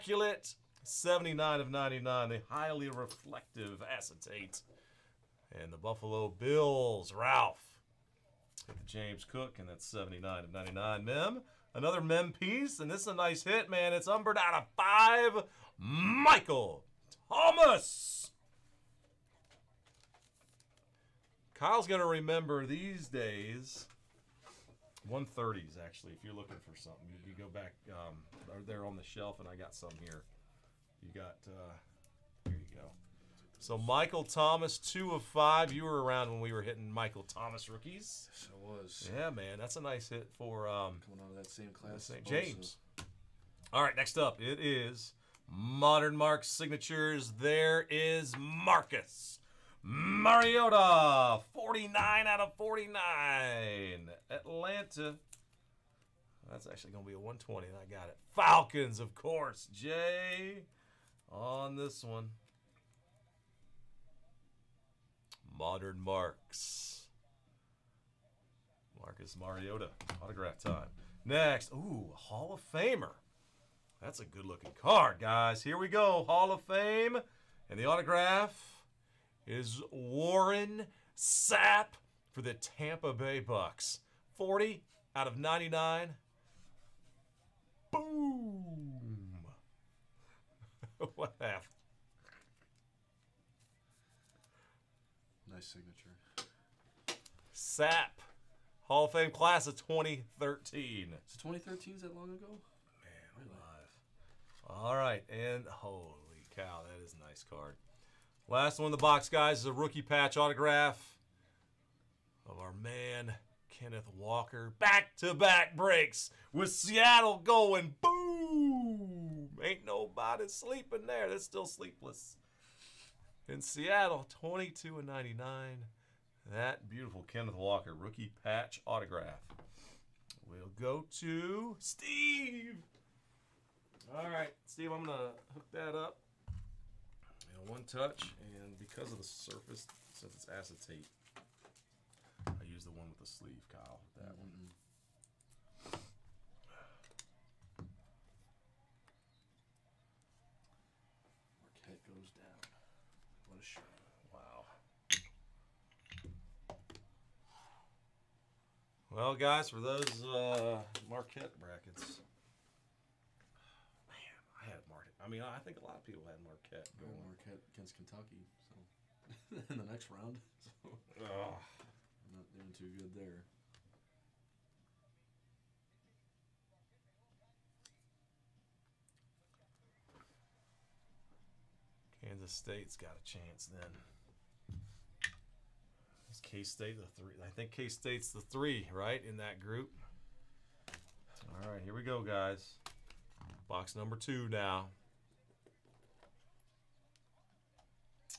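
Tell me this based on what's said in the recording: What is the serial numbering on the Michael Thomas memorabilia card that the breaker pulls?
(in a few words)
2 of 5.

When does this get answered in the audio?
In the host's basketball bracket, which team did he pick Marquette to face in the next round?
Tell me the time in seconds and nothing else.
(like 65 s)
167 s.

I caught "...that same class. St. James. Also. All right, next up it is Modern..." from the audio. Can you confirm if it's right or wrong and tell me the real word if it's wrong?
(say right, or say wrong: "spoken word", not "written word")
right.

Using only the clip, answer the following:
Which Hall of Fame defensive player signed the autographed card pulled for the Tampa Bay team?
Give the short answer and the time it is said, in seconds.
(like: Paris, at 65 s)
Warren Sapp, at 79 s.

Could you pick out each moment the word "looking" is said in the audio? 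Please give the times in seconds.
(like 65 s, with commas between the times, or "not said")
26 s, 74 s.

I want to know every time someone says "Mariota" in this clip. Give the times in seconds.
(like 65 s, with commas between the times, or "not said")
49 s, 69 s.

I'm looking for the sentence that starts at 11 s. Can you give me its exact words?
Mem, Another mem piece, and this is a nice hit, man.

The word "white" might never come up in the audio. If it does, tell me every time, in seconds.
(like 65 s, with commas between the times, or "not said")
not said.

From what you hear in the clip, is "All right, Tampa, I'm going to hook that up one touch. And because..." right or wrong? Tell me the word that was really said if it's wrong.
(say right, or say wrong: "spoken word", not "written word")
wrong: "Steve", not "Tampa".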